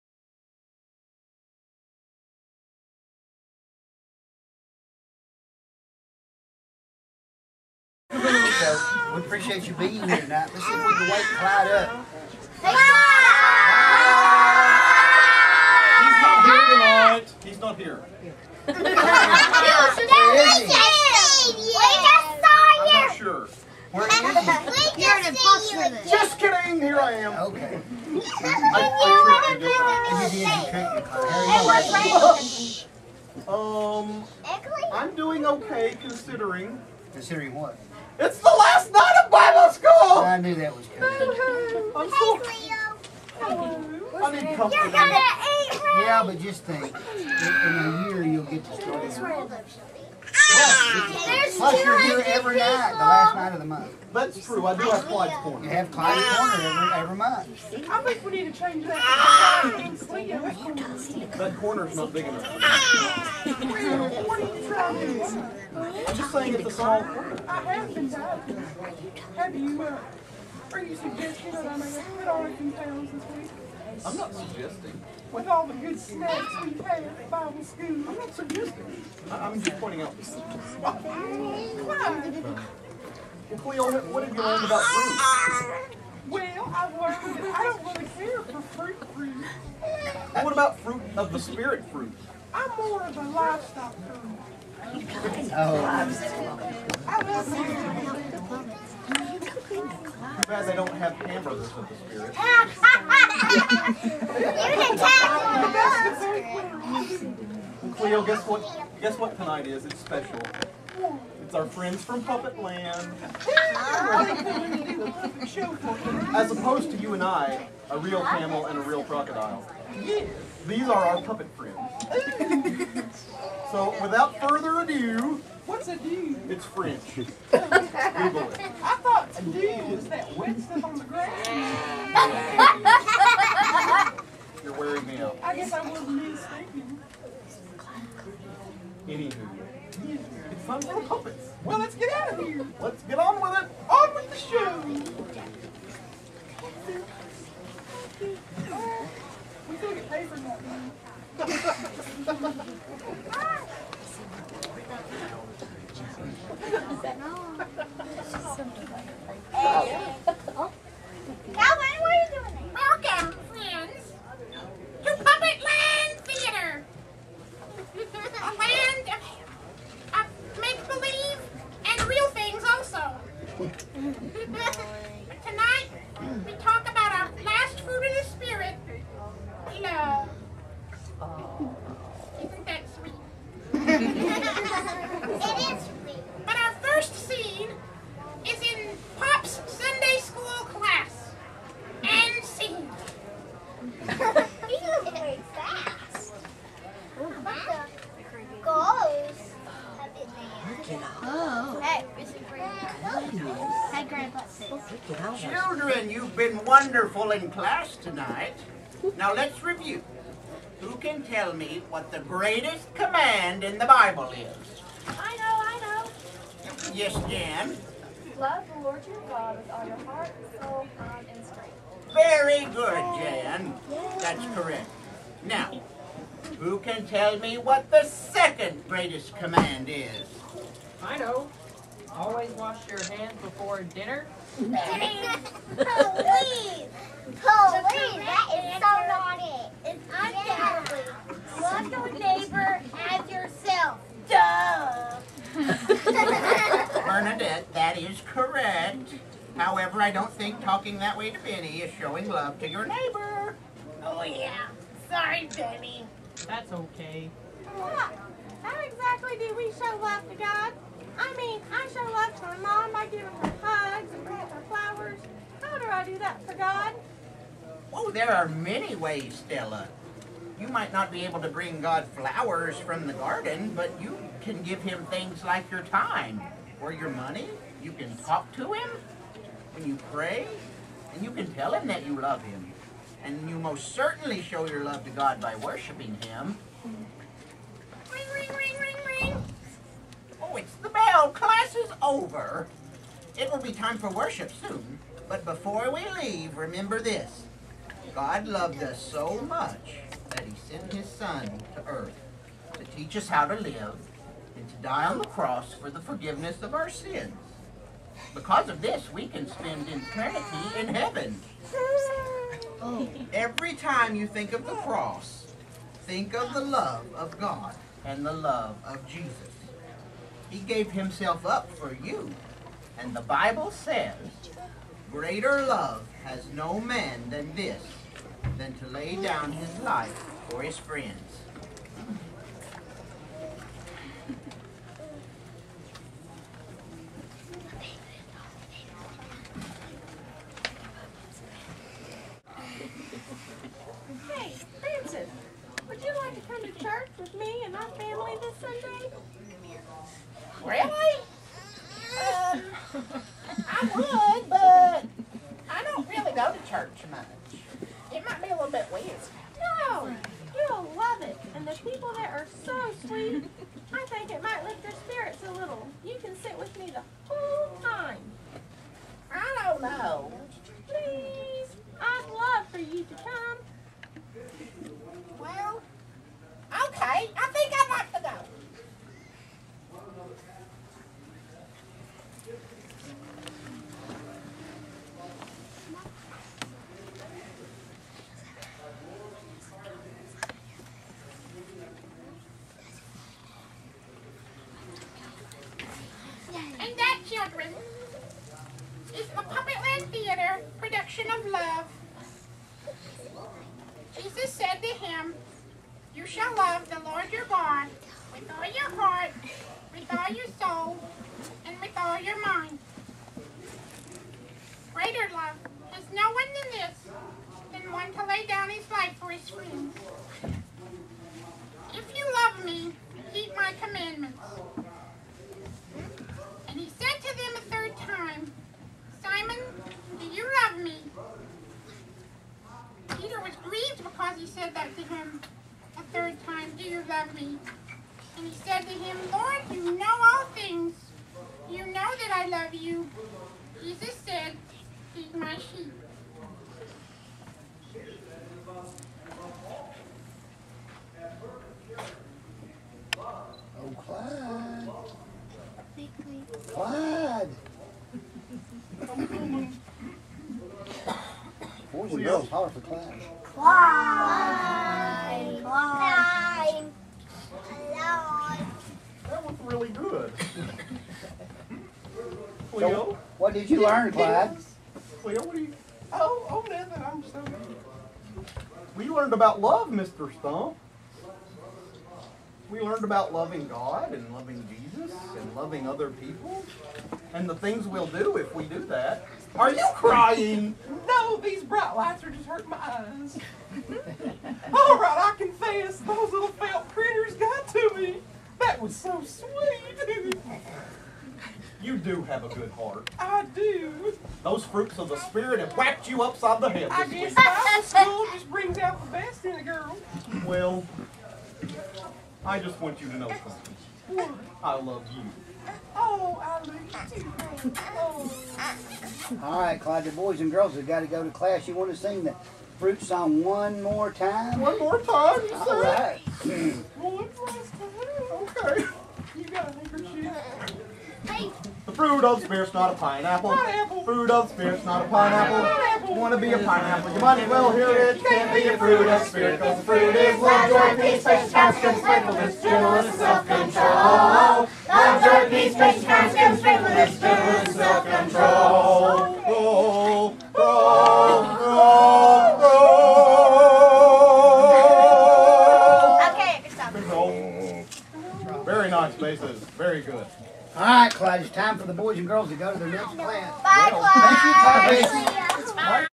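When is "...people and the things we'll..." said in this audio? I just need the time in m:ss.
8:06.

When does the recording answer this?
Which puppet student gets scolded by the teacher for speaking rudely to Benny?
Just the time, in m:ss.
4:07.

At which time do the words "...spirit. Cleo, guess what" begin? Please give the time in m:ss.
1:47.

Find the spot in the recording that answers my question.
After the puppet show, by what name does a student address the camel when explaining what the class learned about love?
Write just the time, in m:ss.
7:59.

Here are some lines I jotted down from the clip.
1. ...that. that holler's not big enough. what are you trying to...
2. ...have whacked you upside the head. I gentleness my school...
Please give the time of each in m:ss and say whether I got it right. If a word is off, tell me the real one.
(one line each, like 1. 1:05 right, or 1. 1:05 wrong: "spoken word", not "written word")
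1. 0:58 wrong: "corner", not "holler"
2. 8:25 wrong: "guess", not "gentleness".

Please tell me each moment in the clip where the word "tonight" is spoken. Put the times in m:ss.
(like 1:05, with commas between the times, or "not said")
0:10, 0:16, 1:49, 3:27.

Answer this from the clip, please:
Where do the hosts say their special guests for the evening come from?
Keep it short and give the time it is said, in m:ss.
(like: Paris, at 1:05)
Puppet Land, at 1:52.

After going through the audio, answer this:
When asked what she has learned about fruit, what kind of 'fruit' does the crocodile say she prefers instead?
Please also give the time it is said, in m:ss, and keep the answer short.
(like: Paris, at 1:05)
livestock fruit, at 1:33.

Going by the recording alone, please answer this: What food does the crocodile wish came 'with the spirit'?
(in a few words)
hamburgers.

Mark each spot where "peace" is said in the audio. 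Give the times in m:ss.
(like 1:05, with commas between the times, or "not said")
9:00, 9:05.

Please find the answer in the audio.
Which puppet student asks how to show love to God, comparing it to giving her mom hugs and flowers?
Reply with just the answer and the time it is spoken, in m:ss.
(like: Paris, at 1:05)
Stella, at 4:29.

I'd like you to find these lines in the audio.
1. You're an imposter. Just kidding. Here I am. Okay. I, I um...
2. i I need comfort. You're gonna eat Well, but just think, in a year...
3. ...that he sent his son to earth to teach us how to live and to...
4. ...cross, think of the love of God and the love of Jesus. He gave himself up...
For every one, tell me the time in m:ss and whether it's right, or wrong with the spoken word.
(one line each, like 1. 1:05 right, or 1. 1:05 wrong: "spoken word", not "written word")
1. 0:25 right
2. 0:41 wrong: "Yeah", not "Well"
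3. 5:00 right
4. 5:14 right.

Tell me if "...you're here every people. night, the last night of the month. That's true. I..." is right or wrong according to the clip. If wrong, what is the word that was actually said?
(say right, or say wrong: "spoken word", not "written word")
right.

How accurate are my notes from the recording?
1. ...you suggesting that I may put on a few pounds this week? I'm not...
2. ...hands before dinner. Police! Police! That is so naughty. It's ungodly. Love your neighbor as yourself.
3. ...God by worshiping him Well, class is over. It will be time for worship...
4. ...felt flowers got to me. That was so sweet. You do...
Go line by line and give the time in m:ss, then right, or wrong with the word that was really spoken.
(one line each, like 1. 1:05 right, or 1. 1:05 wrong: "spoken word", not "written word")
1. 1:10 right
2. 3:53 right
3. 4:45 right
4. 8:16 wrong: "critters", not "flowers".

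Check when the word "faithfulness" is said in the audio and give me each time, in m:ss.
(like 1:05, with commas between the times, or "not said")
9:02, 9:06.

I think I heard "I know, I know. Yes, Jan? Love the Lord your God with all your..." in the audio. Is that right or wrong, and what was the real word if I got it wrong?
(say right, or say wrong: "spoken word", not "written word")
right.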